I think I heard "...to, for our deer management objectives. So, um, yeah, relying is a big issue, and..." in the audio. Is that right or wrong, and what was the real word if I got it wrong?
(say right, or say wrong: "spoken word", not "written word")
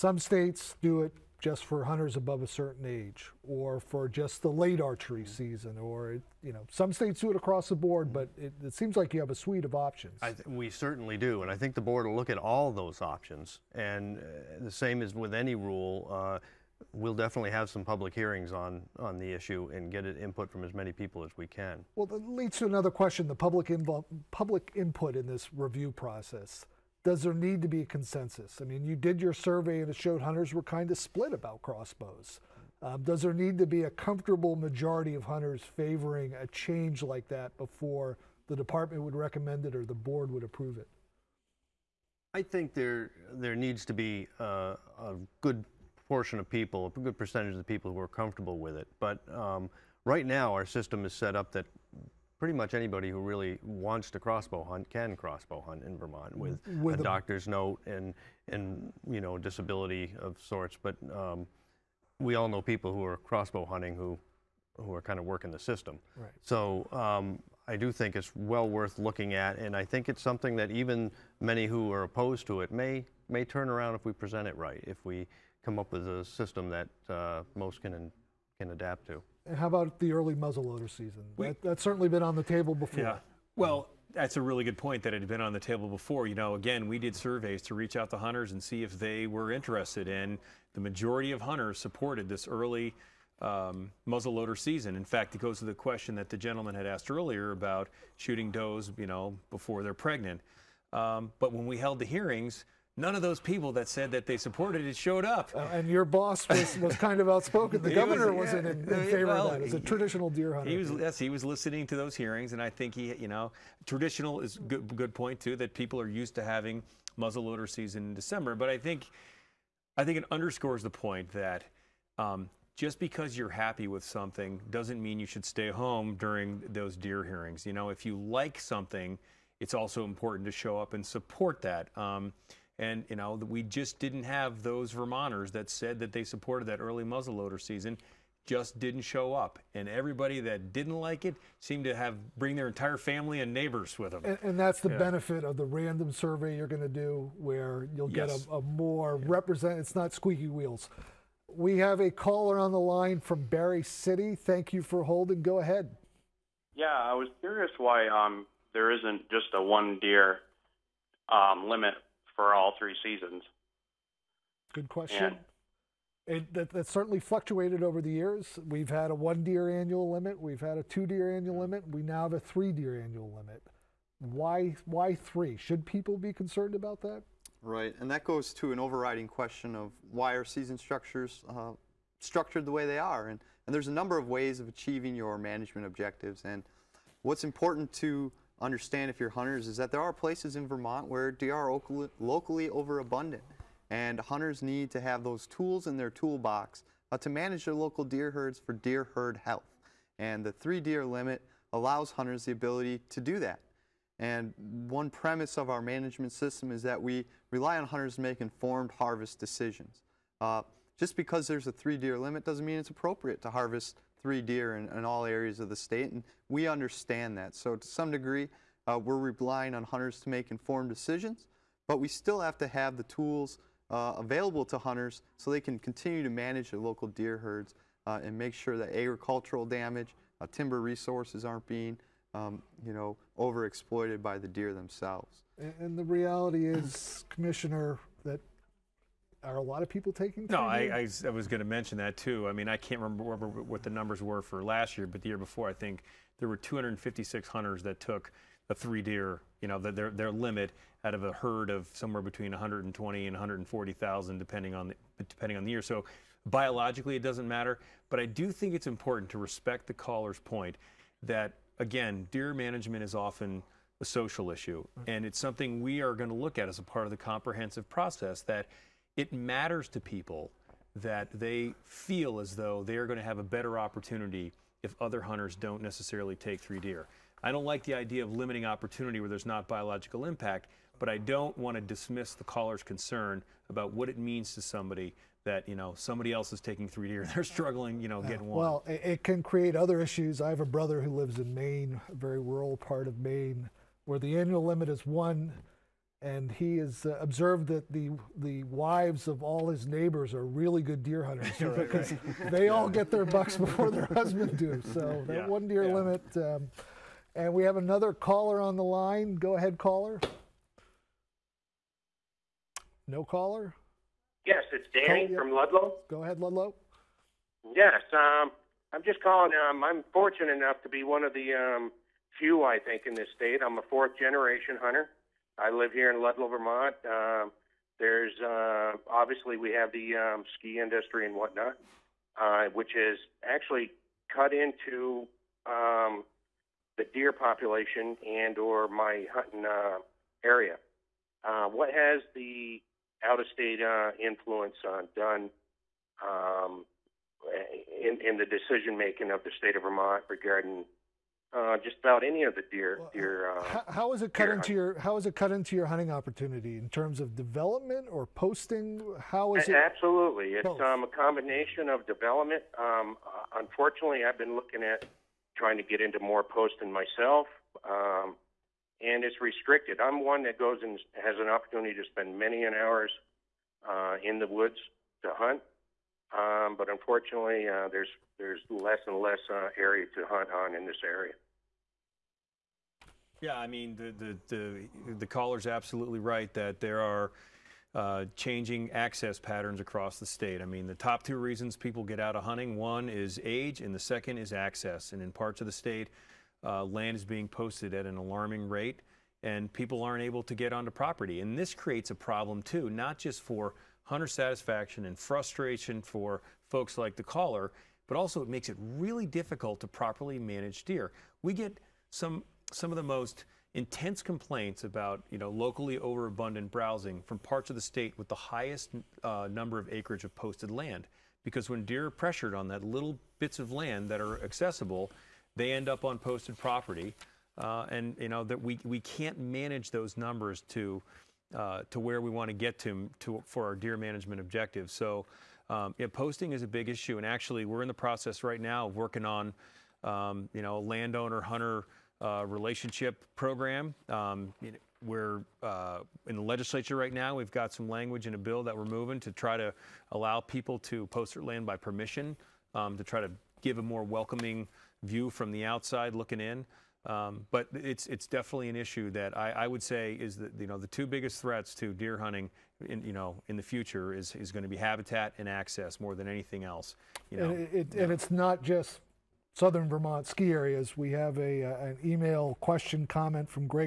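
wrong: "posting", not "relying".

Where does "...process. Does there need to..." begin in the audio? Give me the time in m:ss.
0:25.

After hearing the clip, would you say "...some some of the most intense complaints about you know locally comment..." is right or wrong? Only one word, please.
wrong.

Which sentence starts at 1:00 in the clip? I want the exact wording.
But um, we all know people who are crossbow hunting who who are kind of working the system.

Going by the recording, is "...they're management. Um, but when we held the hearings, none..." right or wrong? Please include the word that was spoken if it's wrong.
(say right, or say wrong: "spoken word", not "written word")
wrong: "pregnant", not "management".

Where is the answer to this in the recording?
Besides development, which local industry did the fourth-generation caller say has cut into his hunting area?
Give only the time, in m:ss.
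5:30.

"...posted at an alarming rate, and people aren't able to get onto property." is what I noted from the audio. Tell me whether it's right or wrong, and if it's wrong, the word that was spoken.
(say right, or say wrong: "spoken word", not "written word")
right.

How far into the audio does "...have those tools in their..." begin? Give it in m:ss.
3:15.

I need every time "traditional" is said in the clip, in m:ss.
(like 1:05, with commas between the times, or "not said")
1:49, 1:53.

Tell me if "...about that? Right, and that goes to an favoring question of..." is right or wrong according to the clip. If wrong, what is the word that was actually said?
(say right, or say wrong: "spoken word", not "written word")
wrong: "overriding", not "favoring".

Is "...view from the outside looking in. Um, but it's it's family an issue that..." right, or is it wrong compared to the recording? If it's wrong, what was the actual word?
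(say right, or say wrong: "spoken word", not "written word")
wrong: "definitely", not "family".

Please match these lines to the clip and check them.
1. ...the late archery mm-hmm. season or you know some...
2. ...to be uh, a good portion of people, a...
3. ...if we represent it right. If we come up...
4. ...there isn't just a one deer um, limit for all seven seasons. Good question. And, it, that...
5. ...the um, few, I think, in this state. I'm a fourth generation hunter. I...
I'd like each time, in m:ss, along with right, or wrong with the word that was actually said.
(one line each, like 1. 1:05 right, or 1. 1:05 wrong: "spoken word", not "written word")
1. 0:04 right
2. 0:43 right
3. 1:13 wrong: "present", not "represent"
4. 2:38 wrong: "three", not "seven"
5. 5:21 right.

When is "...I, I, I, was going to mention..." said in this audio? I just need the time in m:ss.
4:00.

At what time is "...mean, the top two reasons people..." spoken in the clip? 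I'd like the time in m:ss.
6:30.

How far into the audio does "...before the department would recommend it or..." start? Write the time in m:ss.
0:37.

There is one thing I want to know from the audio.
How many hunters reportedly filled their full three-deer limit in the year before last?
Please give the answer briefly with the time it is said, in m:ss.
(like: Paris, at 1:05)
256, at 4:06.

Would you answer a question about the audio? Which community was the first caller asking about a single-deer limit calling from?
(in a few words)
Barre City.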